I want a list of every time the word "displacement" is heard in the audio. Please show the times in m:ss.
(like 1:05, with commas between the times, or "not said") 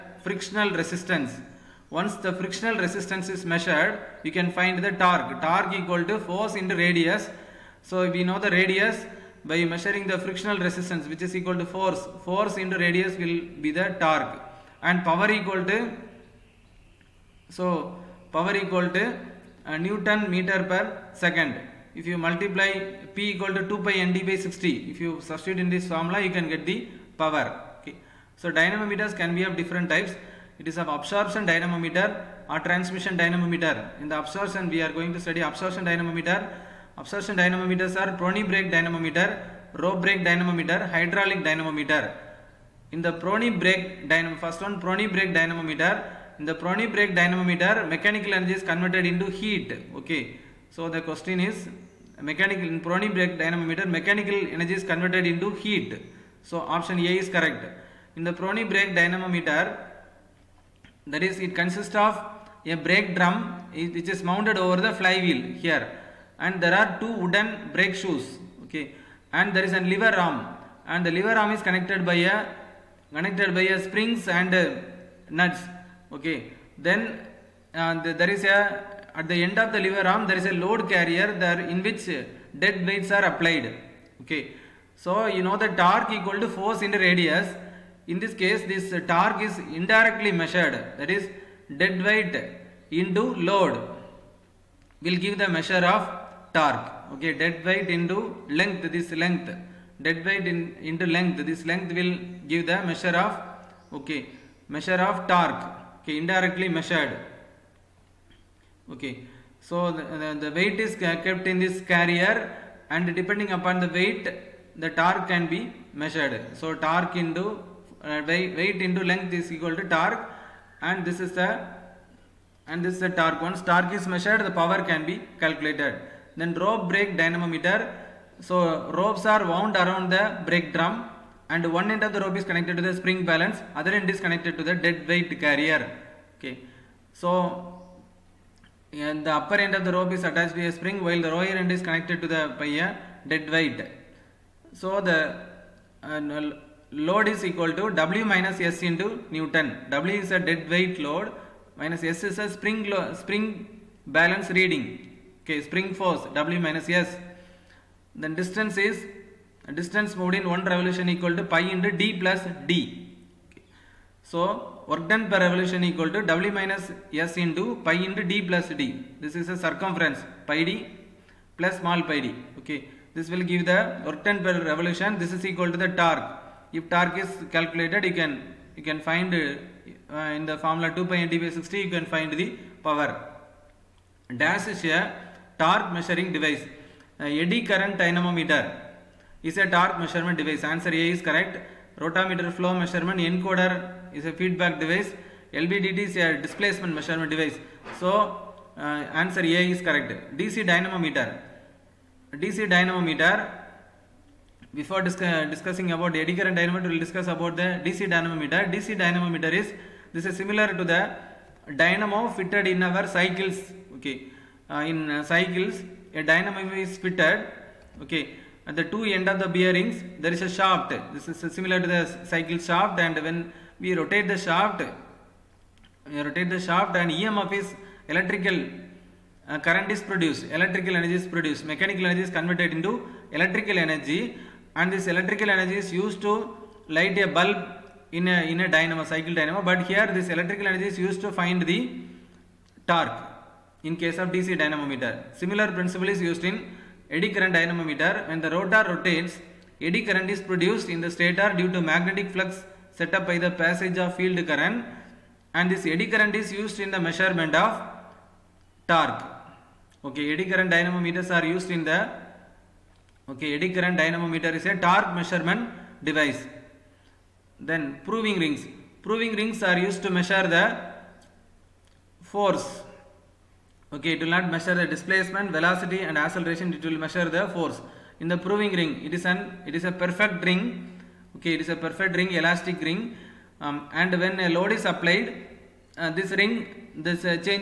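3:16, 4:34.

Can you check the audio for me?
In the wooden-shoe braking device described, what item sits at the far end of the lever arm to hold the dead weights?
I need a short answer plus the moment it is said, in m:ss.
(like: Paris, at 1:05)
Load carrier, at 1:20.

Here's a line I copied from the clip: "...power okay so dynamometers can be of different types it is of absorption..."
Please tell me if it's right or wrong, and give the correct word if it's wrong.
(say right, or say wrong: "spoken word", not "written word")
right.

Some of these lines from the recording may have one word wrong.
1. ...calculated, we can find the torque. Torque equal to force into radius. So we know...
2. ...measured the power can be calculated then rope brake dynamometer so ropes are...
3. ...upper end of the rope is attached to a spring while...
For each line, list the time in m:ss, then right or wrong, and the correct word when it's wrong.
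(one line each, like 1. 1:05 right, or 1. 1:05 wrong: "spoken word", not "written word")
1. 0:03 wrong: "measured", not "calculated"
2. 2:04 right
3. 2:19 right.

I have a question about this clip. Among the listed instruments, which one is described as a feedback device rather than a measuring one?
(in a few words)
Encoder.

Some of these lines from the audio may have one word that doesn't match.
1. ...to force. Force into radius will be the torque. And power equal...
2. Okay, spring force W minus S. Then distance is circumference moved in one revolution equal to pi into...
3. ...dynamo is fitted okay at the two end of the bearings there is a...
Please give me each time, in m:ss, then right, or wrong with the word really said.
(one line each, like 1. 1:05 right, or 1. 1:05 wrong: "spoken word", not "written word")
1. 0:11 right
2. 2:35 wrong: "distance", not "circumference"
3. 3:36 right.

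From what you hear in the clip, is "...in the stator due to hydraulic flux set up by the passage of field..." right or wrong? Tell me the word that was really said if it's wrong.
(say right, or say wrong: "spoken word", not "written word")
wrong: "magnetic", not "hydraulic".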